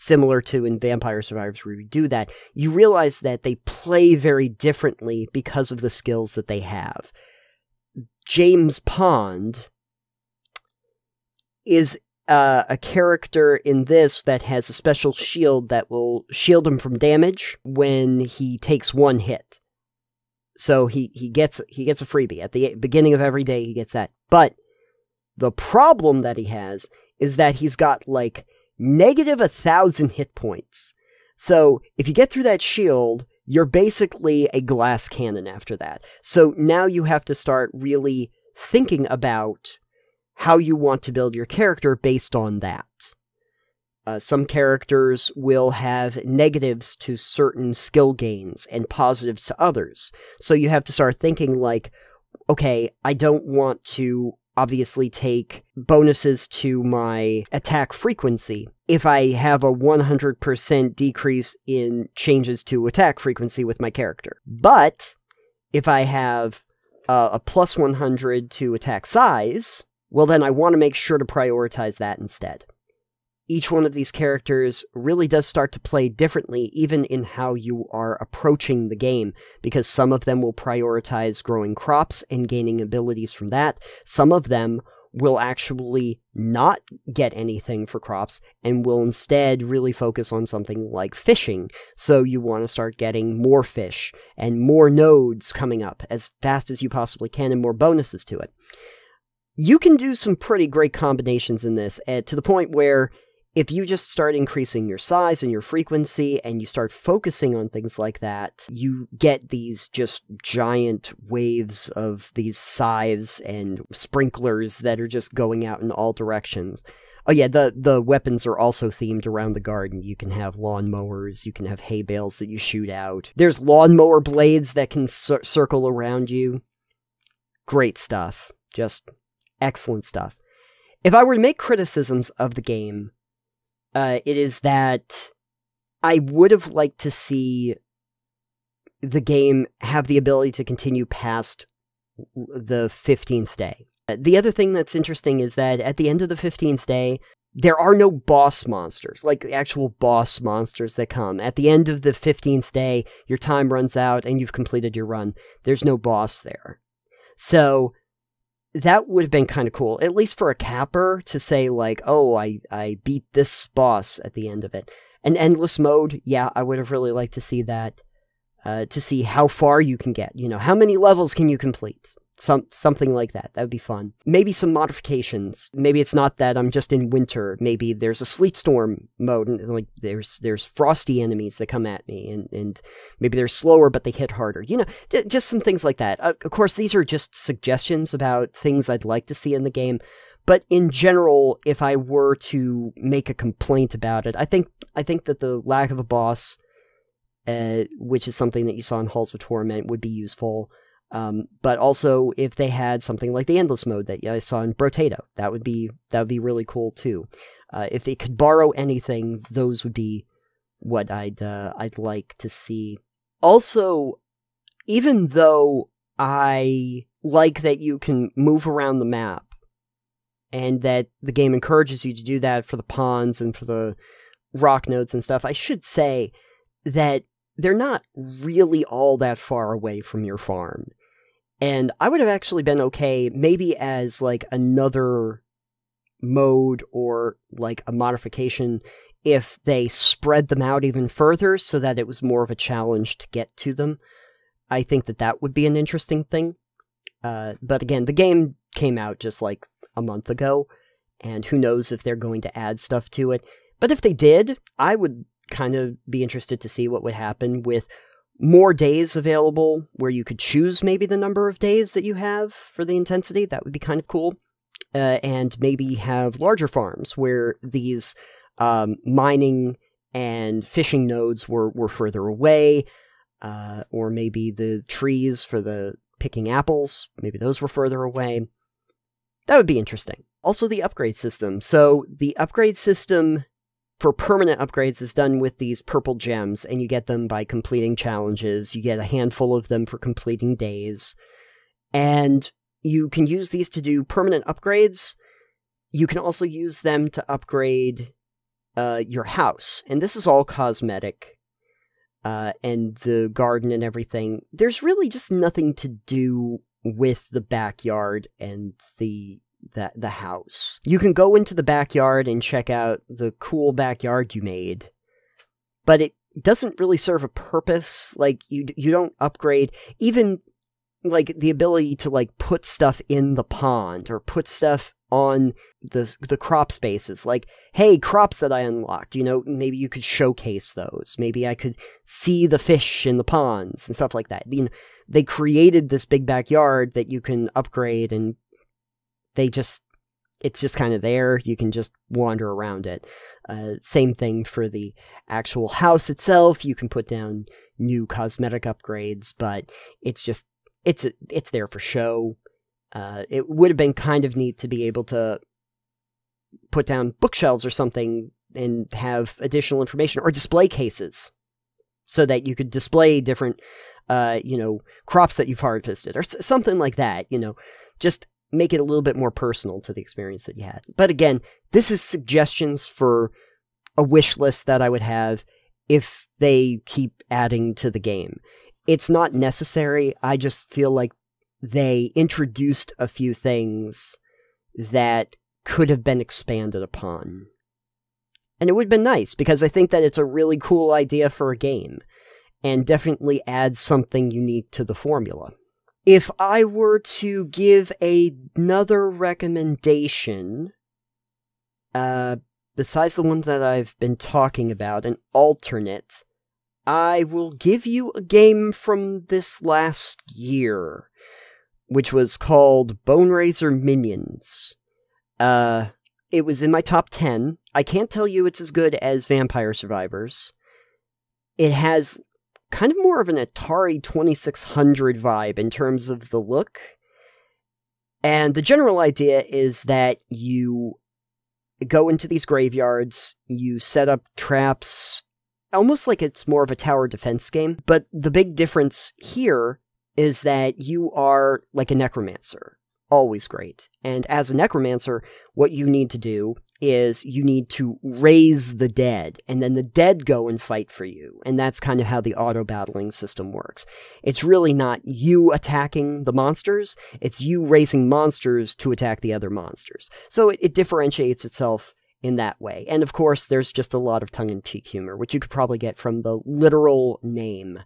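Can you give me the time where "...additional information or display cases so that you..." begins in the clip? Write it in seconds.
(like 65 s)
359 s.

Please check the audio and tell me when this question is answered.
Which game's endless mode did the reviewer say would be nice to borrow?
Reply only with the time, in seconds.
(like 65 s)
204 s.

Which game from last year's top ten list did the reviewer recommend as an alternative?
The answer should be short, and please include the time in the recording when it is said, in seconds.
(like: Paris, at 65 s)
Boneraiser Minions, at 413 s.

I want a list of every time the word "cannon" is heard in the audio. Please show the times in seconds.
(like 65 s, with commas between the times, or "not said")
35 s.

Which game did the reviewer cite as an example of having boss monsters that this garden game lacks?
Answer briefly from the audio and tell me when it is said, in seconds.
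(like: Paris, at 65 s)
Halls of Torment, at 199 s.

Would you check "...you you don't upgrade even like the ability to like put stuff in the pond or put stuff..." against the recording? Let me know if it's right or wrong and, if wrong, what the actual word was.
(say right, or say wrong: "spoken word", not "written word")
right.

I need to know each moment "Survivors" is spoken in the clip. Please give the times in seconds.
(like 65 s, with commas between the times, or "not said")
1 s, 419 s.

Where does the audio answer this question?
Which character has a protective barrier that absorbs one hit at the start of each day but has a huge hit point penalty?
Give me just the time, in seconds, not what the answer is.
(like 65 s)
8 s.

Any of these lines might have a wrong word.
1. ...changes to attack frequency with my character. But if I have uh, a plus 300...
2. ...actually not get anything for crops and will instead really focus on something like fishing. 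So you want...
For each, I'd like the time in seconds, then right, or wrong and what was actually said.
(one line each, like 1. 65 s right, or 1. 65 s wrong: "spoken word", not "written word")
1. 62 s wrong: "100", not "300"
2. 85 s right.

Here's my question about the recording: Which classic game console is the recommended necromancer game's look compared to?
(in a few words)
Atari 2600.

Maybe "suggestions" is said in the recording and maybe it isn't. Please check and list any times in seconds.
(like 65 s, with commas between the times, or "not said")
187 s, 372 s.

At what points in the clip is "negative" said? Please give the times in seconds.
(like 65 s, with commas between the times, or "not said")
28 s, 46 s.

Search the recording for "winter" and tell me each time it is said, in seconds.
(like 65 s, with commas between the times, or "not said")
177 s.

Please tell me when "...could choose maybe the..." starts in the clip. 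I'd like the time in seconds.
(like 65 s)
260 s.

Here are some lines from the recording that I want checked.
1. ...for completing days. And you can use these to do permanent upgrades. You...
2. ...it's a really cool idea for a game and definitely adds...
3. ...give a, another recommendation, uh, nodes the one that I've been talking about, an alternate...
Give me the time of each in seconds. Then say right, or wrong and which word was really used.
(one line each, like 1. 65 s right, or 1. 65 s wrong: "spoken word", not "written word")
1. 289 s right
2. 390 s right
3. 397 s wrong: "besides", not "nodes".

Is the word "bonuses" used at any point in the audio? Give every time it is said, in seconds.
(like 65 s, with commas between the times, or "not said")
55 s, 97 s.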